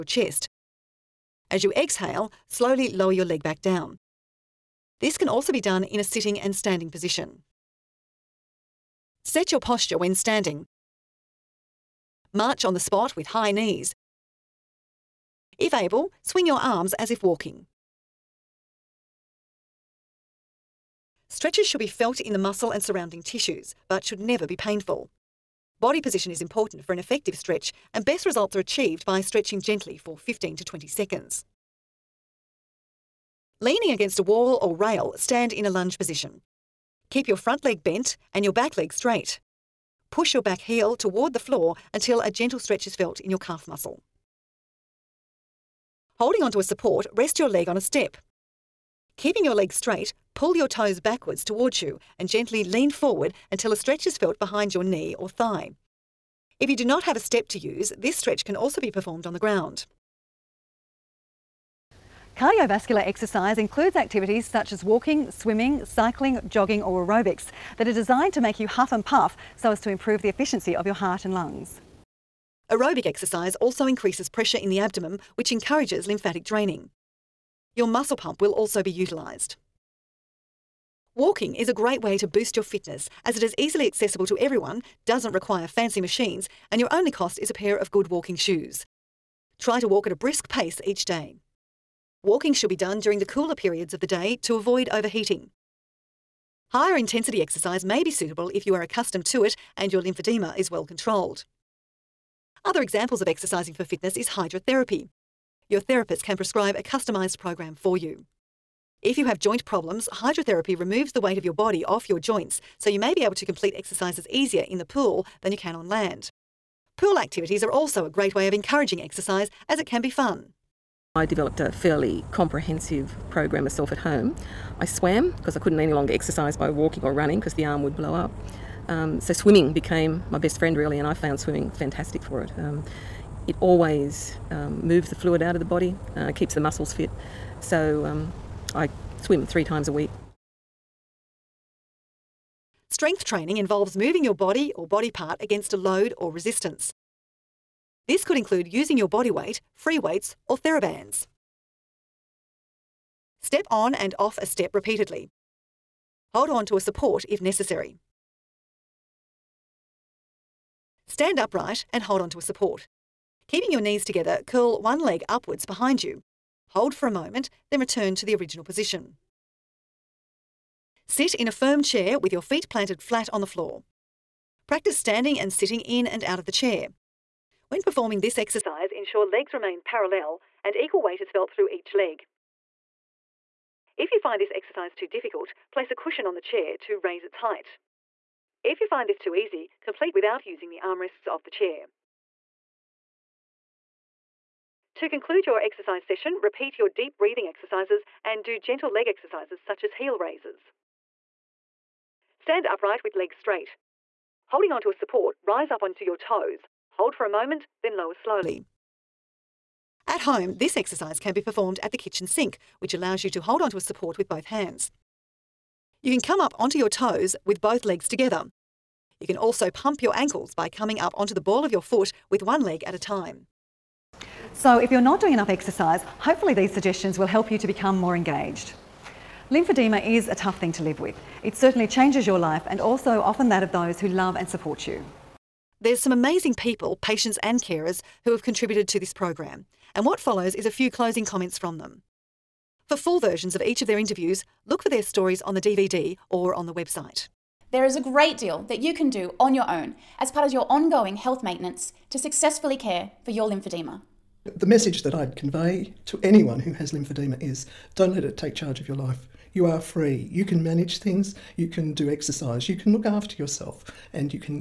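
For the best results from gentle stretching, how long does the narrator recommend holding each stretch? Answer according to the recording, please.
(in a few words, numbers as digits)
15 to 20 seconds.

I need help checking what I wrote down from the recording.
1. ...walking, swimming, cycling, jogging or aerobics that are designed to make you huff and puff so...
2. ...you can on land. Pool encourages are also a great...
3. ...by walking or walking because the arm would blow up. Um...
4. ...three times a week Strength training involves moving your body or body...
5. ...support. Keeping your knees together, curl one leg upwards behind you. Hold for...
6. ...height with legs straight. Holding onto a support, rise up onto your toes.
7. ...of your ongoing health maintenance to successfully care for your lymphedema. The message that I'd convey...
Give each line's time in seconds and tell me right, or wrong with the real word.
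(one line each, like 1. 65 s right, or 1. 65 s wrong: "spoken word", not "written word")
1. 64 s right
2. 115 s wrong: "activities", not "encourages"
3. 126 s wrong: "running", not "walking"
4. 139 s right
5. 162 s right
6. 202 s wrong: "upright", not "height"
7. 250 s right.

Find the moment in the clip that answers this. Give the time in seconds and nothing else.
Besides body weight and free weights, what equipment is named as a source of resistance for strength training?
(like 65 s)
150 s.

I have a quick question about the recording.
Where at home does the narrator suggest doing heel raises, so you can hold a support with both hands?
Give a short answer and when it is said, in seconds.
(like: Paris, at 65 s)
kitchen sink, at 211 s.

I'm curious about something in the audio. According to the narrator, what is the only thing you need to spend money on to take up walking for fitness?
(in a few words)
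good walking shoes.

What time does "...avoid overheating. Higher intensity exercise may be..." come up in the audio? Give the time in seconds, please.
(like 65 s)
94 s.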